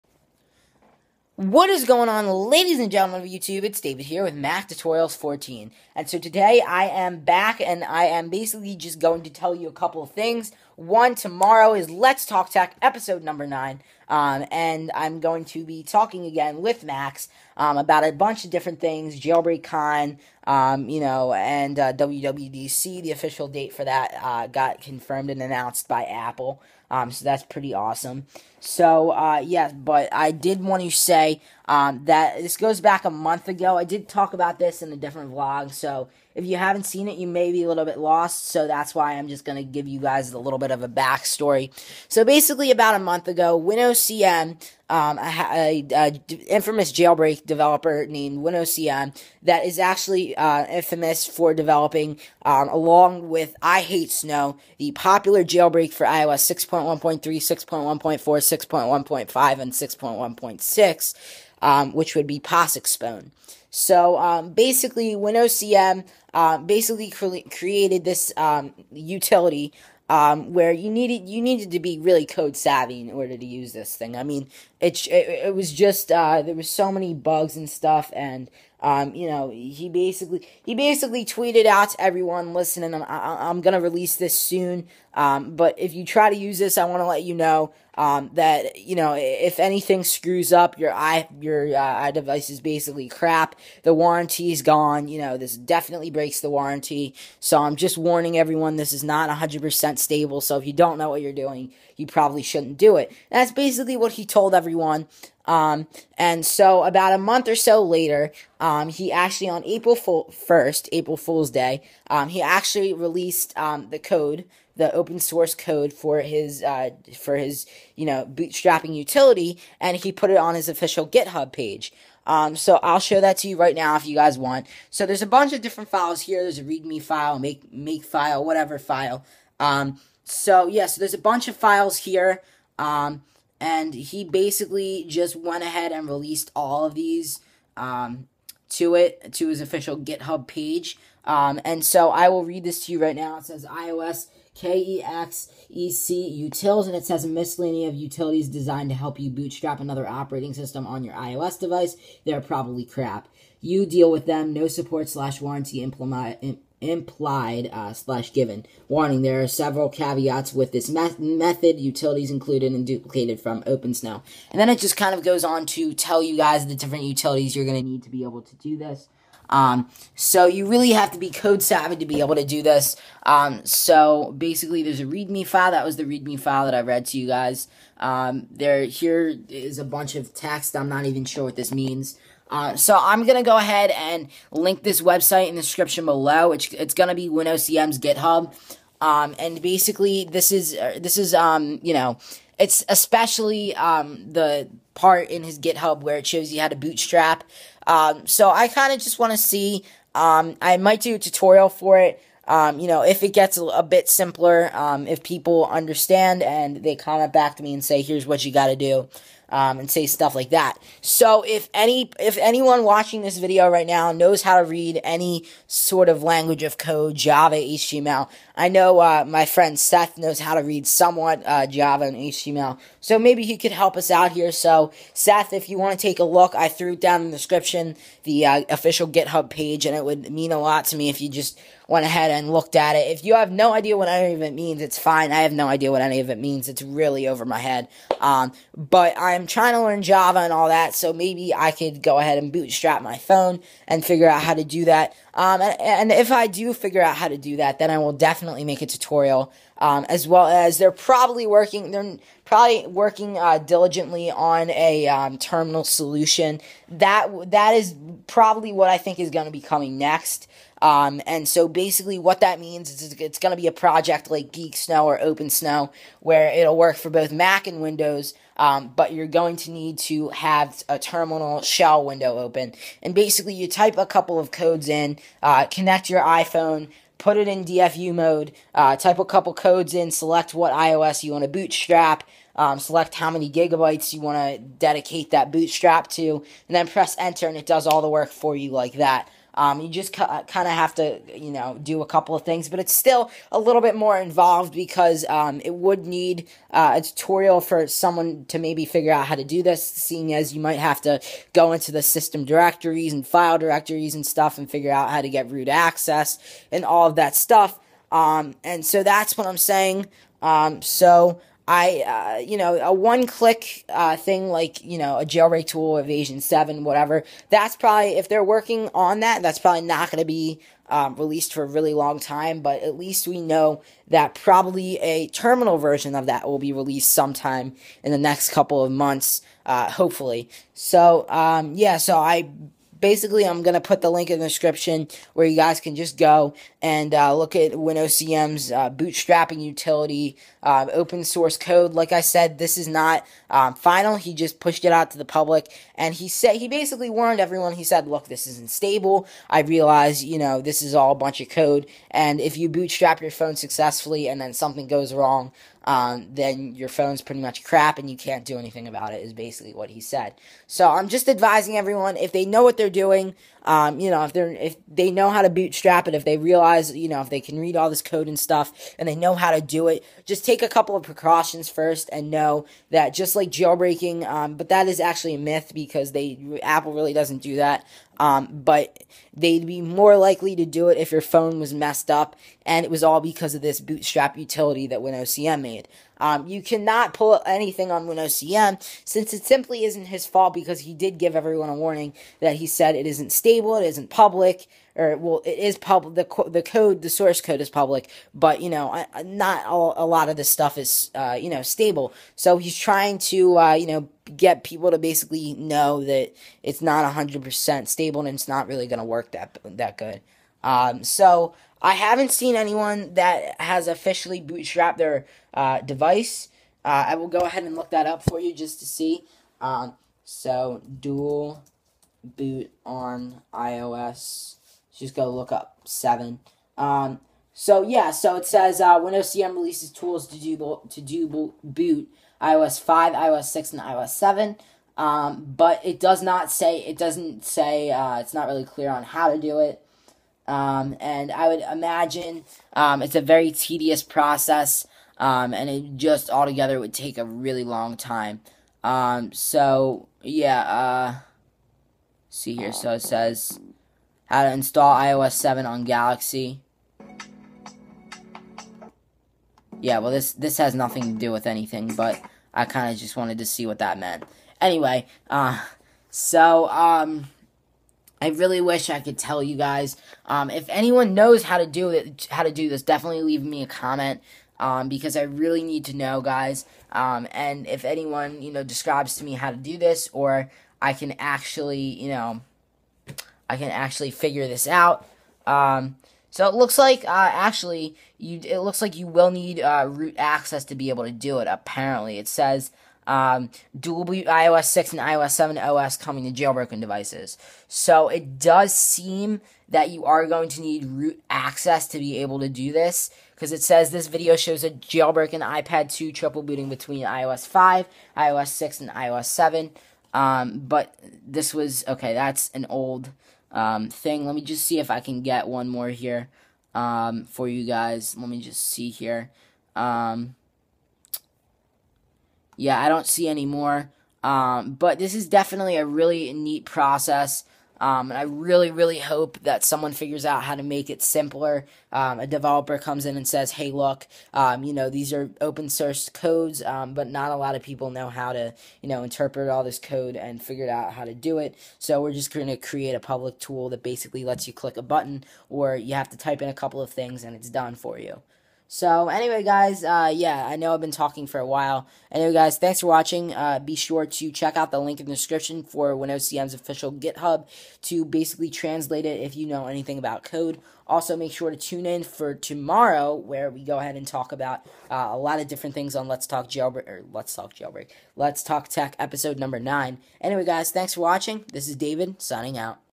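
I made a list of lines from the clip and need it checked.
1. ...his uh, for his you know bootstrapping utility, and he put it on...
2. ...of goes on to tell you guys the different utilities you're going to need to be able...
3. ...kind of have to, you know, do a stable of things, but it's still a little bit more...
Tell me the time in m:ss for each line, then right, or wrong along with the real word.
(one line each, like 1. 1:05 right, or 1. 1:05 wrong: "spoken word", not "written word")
1. 1:56 right
2. 2:45 right
3. 4:50 wrong: "couple", not "stable".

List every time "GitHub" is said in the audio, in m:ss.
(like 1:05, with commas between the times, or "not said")
2:01, 2:19, 3:07, 3:15, 3:49, 9:16.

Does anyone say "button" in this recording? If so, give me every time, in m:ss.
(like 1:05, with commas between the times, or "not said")
9:04.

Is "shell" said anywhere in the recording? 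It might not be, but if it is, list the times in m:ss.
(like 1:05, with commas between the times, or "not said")
4:31.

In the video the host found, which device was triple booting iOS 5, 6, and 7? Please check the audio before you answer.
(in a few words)
iPad 2.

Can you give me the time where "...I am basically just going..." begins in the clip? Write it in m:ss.
0:07.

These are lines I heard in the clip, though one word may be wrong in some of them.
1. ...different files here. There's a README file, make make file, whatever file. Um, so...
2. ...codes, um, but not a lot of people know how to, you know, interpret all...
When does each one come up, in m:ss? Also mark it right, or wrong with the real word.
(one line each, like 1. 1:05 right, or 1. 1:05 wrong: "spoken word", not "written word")
1. 2:05 right
2. 8:56 right.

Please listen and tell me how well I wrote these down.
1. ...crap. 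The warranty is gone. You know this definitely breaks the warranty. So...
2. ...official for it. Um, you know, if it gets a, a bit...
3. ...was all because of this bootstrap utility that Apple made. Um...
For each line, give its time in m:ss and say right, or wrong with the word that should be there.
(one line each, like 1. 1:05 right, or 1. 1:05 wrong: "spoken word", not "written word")
1. 1:33 right
2. 3:21 wrong: "tutorial", not "official"
3. 6:22 wrong: "WinOCM", not "Apple".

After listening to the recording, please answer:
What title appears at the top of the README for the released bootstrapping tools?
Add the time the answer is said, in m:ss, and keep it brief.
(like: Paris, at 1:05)
iOS KEXEC utils, at 2:23.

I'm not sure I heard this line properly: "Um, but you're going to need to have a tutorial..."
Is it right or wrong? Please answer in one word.
wrong.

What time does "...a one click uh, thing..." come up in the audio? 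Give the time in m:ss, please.
5:12.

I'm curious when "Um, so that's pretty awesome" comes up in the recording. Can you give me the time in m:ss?
0:26.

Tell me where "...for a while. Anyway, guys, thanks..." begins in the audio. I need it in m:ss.
9:11.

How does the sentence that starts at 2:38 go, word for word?
Warning: There are several caveats with this me- method.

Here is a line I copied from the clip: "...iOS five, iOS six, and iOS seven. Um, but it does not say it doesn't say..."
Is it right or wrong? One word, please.
right.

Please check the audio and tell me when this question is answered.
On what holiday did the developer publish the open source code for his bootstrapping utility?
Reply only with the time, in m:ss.
1:50.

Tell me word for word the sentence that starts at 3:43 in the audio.
So maybe he could help us out here.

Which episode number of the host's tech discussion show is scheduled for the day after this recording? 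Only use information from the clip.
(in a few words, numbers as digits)
9.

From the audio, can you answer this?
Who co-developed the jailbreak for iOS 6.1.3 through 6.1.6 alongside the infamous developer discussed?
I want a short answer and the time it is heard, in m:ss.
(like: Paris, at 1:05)
iH8sn0w, at 0:53.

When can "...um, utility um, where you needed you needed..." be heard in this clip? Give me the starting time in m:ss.
1:08.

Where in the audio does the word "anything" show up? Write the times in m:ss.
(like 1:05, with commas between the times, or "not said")
1:29, 5:58, 6:27, 7:41, 9:19.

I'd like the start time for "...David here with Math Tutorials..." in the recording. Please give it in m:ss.
0:03.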